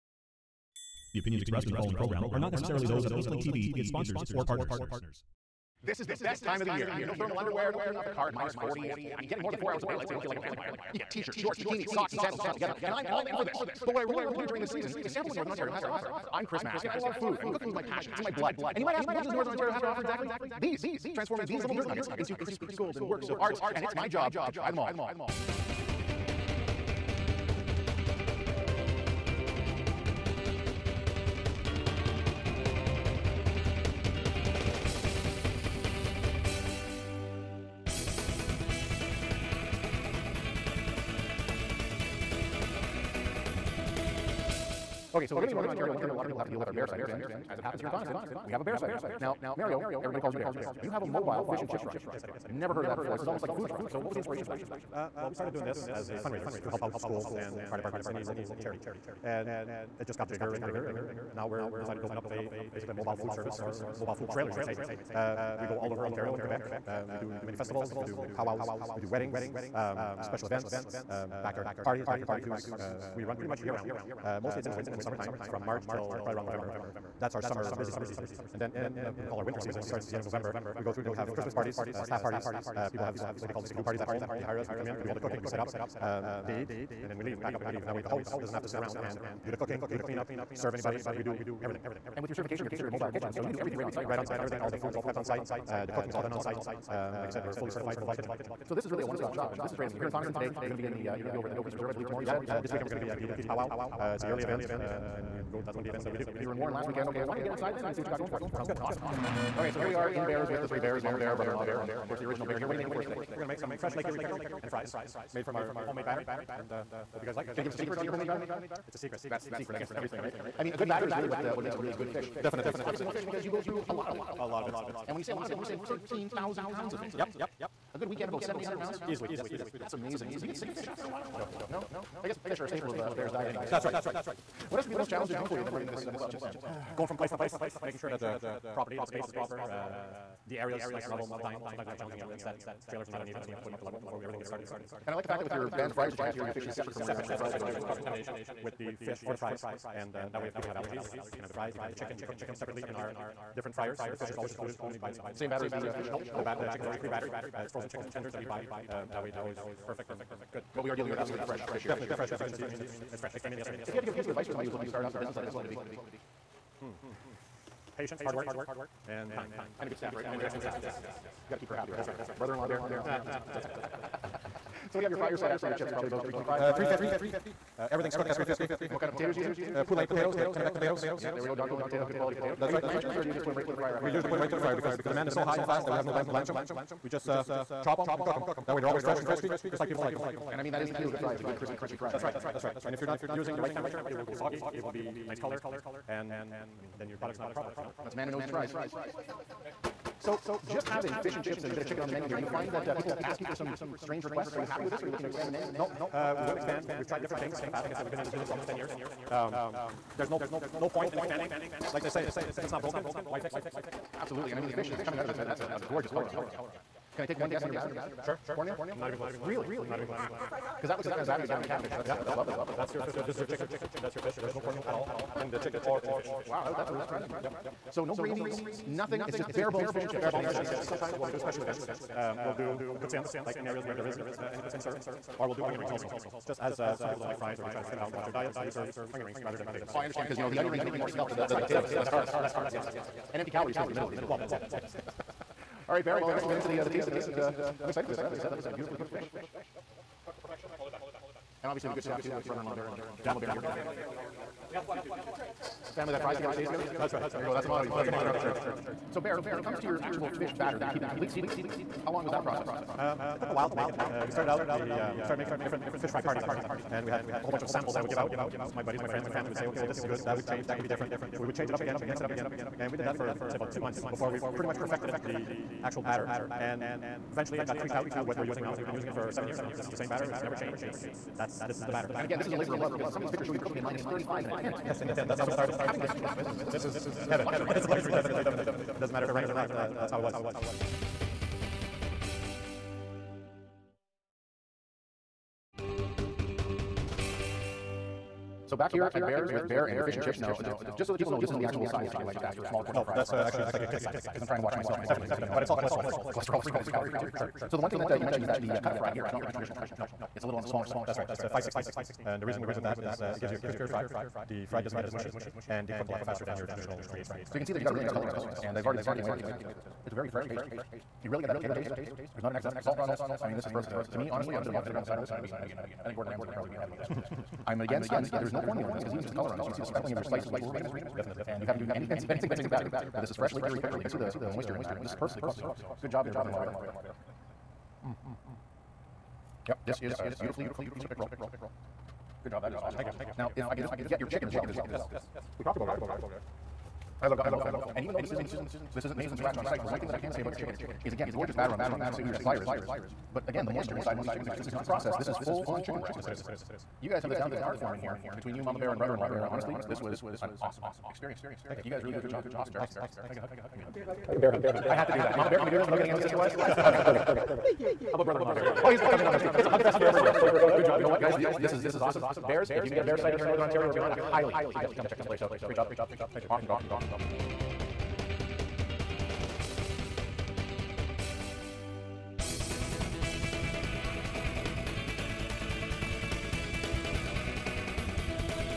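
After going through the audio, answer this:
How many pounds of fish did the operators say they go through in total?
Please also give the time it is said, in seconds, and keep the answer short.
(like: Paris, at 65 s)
13,000, at 125 s.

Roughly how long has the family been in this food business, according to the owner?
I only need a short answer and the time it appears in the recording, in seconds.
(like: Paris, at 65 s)
almost 10 years, at 208 s.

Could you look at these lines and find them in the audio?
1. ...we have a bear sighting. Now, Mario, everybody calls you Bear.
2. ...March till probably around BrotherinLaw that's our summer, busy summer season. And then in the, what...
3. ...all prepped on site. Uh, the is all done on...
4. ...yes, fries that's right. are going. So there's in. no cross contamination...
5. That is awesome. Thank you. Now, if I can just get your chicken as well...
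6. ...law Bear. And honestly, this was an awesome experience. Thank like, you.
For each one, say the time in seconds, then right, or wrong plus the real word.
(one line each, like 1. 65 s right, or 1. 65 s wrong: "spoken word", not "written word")
1. 48 s right
2. 75 s wrong: "November", not "BrotherinLaw"
3. 94 s right
4. 147 s right
5. 342 s right
6. 359 s right.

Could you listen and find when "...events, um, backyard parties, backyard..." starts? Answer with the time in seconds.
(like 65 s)
70 s.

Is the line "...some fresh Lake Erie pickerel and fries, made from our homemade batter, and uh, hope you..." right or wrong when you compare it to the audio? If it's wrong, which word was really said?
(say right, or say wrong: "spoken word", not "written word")
right.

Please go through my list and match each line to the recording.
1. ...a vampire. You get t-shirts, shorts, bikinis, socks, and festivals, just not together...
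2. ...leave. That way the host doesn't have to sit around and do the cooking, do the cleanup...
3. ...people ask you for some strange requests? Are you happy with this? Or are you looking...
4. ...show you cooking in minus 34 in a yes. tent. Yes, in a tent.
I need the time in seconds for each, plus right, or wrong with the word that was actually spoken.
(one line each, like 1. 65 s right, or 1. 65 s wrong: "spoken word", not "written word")
1. 10 s wrong: "sandals", not "festivals"
2. 87 s right
3. 202 s right
4. 283 s wrong: "35", not "34".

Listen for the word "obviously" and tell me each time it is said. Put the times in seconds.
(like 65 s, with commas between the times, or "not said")
122 s, 251 s.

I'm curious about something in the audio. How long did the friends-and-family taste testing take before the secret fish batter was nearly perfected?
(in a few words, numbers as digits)
about two months.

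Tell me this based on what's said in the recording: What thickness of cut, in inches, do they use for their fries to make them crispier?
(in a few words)
5/16.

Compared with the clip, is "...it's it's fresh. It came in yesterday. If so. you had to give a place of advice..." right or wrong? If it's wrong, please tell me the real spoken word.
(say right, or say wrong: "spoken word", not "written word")
wrong: "piece", not "place".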